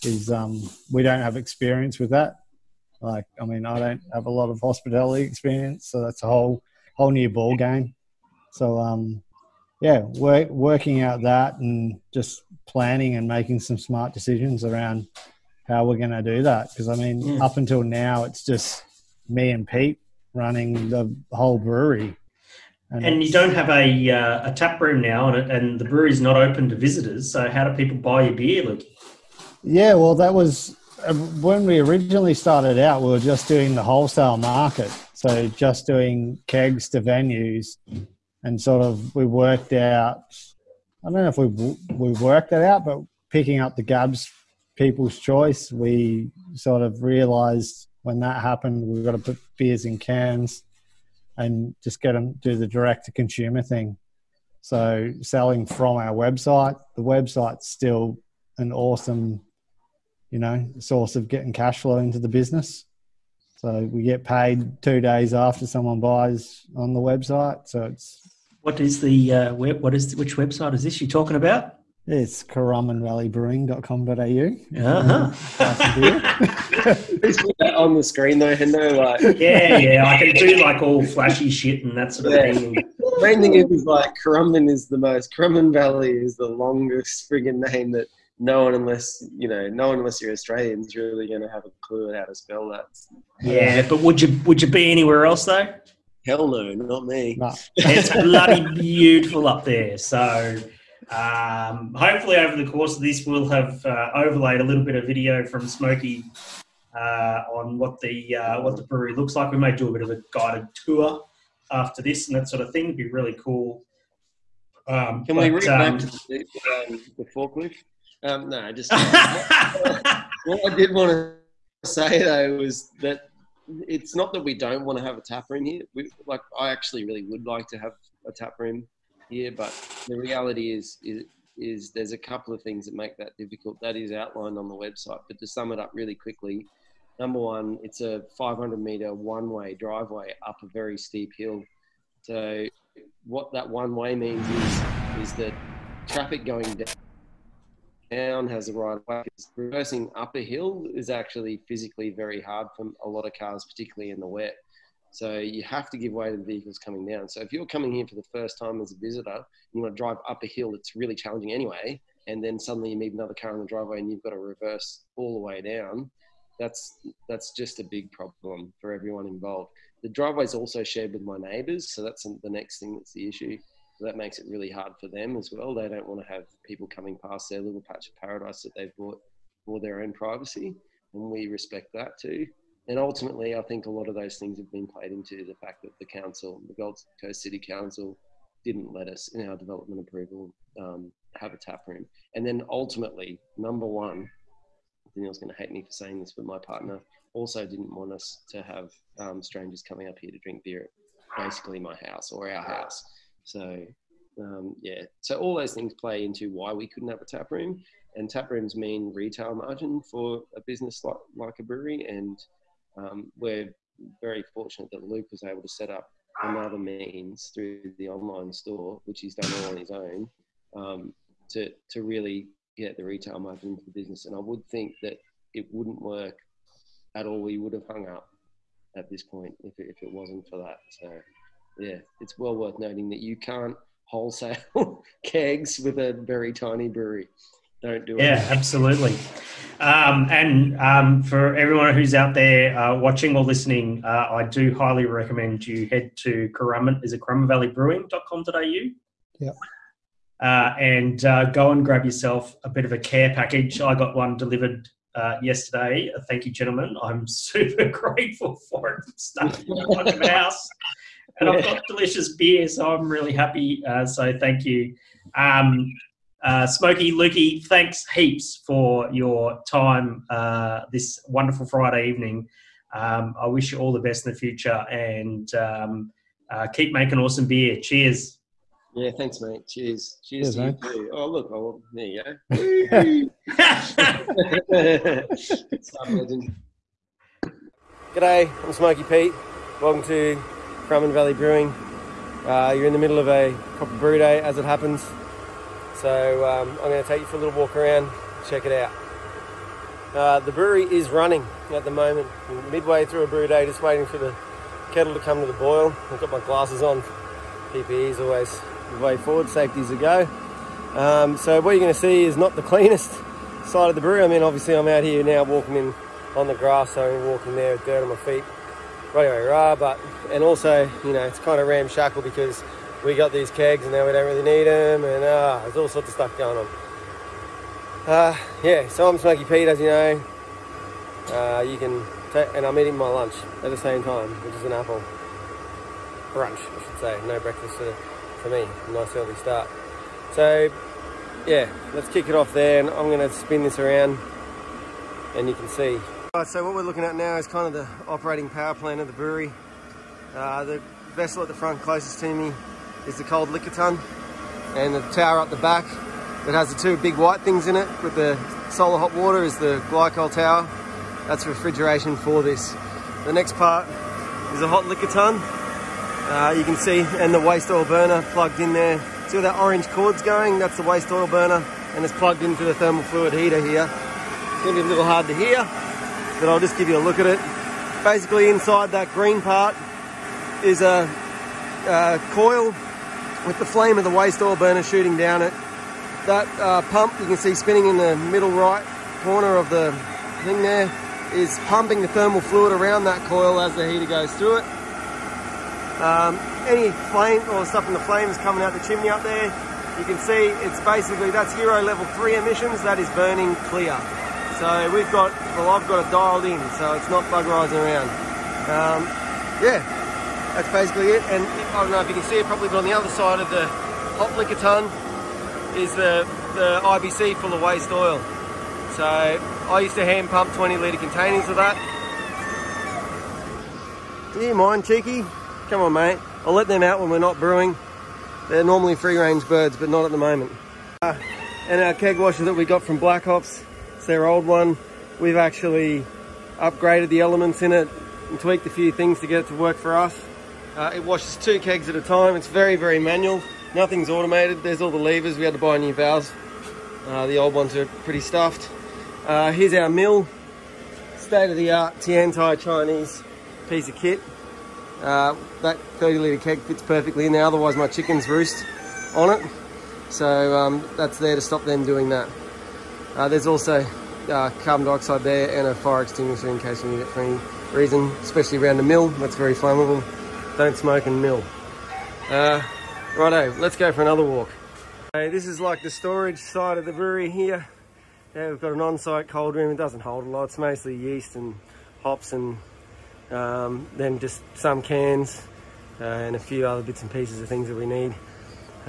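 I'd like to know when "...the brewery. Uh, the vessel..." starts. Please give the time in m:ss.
5:49.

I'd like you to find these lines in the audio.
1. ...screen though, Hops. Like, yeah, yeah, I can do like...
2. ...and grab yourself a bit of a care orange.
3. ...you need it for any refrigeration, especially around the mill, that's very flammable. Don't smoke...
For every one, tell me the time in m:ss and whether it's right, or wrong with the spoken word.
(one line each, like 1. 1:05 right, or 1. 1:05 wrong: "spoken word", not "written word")
1. 1:18 wrong: "Hendo", not "Hops"
2. 4:11 wrong: "package", not "orange"
3. 7:46 wrong: "reason", not "refrigeration".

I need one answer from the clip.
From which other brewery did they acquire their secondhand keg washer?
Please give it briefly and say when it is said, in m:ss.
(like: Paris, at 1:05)
Black Hops, at 7:12.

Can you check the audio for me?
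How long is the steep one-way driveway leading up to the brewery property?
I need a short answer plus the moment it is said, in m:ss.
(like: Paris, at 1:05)
500 meters, at 2:18.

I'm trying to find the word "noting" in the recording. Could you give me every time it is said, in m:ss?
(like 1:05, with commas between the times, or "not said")
3:52.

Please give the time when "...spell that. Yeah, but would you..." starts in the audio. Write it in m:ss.
1:32.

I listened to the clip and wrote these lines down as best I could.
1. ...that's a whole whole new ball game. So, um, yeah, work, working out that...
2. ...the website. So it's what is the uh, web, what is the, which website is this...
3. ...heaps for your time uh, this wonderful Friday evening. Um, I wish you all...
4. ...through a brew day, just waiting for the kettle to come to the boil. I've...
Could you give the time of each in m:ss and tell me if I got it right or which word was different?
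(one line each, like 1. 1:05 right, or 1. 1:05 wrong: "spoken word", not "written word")
1. 0:06 right
2. 1:06 right
3. 4:28 right
4. 5:03 right.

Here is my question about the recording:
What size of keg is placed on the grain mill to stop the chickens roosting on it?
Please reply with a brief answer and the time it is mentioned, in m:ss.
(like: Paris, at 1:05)
30 litre, at 7:35.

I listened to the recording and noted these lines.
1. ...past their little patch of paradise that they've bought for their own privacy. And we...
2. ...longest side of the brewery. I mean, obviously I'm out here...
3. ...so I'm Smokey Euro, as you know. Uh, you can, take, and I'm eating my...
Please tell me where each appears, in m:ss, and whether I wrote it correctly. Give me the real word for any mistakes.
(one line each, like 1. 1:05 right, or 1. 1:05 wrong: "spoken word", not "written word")
1. 2:57 right
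2. 5:12 wrong: "cleanest", not "longest"
3. 5:28 wrong: "Pete", not "Euro".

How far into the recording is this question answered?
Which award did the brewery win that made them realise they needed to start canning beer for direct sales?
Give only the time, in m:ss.
0:43.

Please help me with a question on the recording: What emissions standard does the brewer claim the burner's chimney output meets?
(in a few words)
Euro level 3.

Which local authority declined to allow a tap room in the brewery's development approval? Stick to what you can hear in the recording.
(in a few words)
Gold Coast City Council.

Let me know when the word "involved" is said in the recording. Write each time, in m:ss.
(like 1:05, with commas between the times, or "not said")
2:49.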